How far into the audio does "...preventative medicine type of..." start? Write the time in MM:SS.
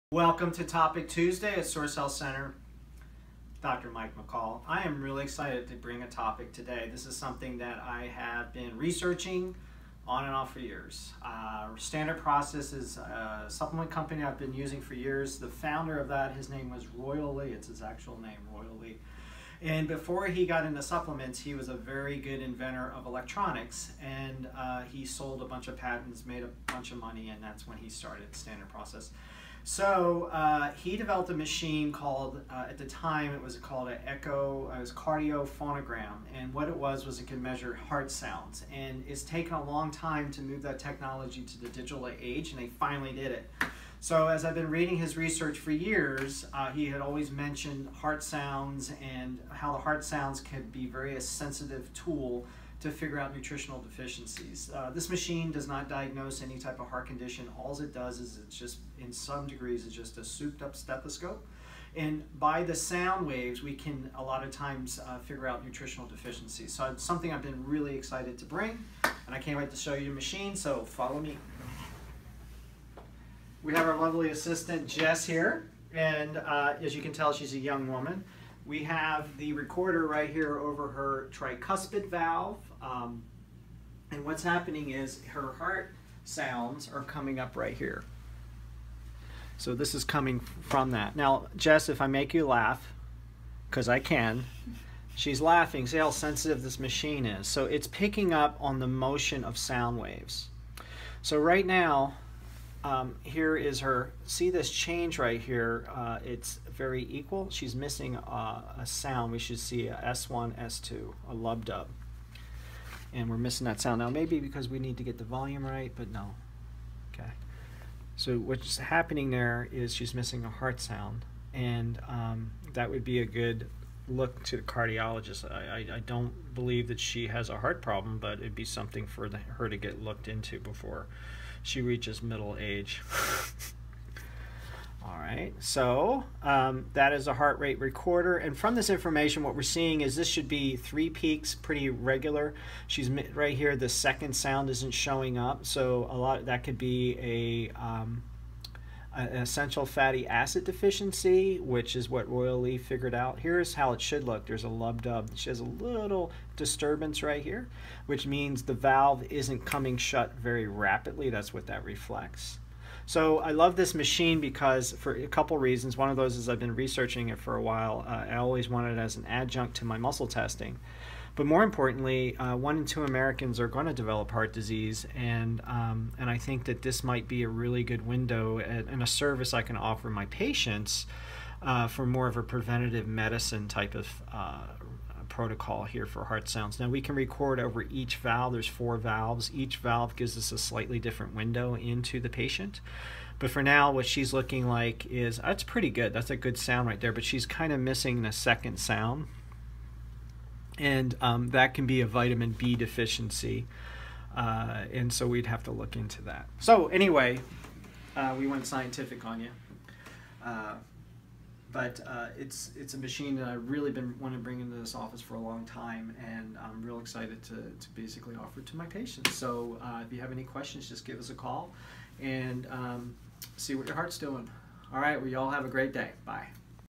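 03:02.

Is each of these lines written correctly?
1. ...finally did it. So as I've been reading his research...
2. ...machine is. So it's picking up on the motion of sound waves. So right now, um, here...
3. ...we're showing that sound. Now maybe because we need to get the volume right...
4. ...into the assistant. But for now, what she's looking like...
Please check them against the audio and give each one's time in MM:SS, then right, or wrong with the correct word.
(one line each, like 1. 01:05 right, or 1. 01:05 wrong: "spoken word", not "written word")
1. 00:42 right
2. 01:36 right
3. 01:53 wrong: "missing", not "showing"
4. 03:11 wrong: "patient", not "assistant".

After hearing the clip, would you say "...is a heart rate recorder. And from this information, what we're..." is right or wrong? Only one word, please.
right.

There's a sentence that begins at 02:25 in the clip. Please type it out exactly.
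So a lot that could be a um, an essential fatty acid deficiency, which is what Royal Lee figured out.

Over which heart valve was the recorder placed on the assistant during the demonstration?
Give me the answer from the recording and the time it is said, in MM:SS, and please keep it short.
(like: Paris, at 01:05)
tricuspid valve, at 01:21.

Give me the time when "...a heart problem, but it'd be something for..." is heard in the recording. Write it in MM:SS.
02:07.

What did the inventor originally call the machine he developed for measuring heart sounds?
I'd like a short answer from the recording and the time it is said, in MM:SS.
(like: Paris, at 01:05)
cardiophonogram, at 00:34.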